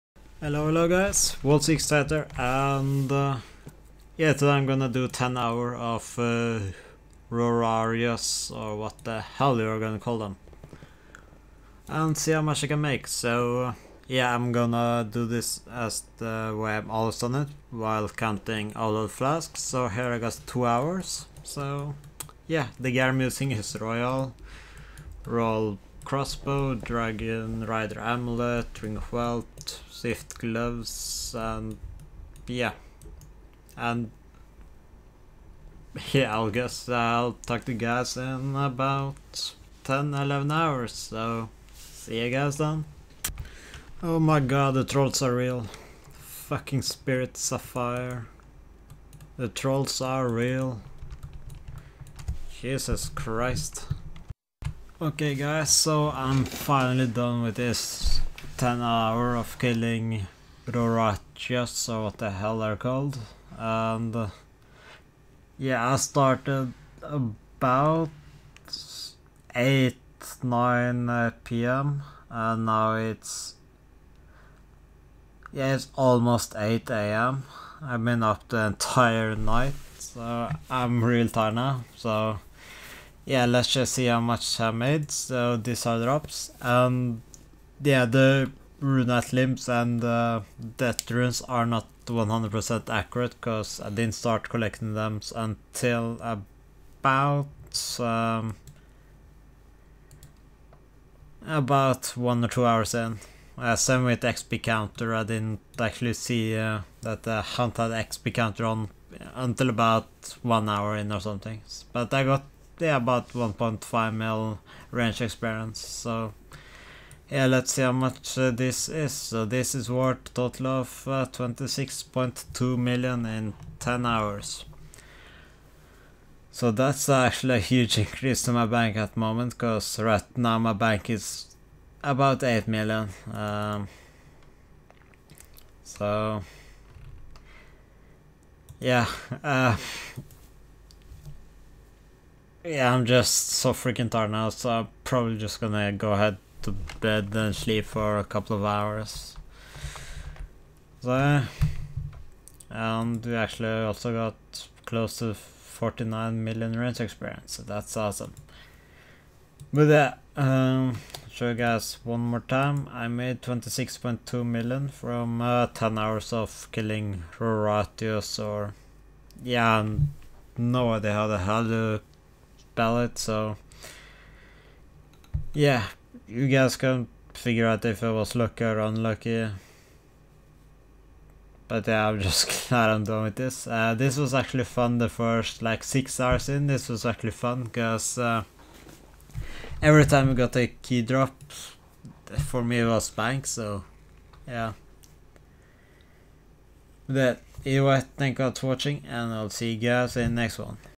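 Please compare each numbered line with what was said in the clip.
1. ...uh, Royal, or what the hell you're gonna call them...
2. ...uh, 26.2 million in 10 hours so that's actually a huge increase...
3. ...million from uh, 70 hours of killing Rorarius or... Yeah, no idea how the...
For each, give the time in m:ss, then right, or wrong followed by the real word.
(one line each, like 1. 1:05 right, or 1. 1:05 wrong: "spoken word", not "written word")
1. 0:06 wrong: "Rorarius", not "Royal"
2. 2:01 right
3. 2:44 wrong: "10", not "70".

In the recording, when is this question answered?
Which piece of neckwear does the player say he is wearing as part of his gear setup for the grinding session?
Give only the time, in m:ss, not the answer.
0:26.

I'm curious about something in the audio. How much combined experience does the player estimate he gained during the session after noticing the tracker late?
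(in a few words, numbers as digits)
1.5 mil.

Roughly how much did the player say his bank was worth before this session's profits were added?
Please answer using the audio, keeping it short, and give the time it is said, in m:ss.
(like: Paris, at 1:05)
8 million, at 2:12.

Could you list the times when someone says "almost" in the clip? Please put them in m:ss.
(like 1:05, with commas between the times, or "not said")
1:15.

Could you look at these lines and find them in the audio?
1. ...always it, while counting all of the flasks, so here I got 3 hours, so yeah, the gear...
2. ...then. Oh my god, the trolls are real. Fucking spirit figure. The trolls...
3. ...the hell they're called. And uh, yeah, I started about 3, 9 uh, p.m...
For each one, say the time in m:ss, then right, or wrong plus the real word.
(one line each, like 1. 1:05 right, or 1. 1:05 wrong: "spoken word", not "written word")
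1. 0:16 wrong: "2", not "3"
2. 0:42 wrong: "sapphire", not "figure"
3. 1:02 wrong: "8", not "3".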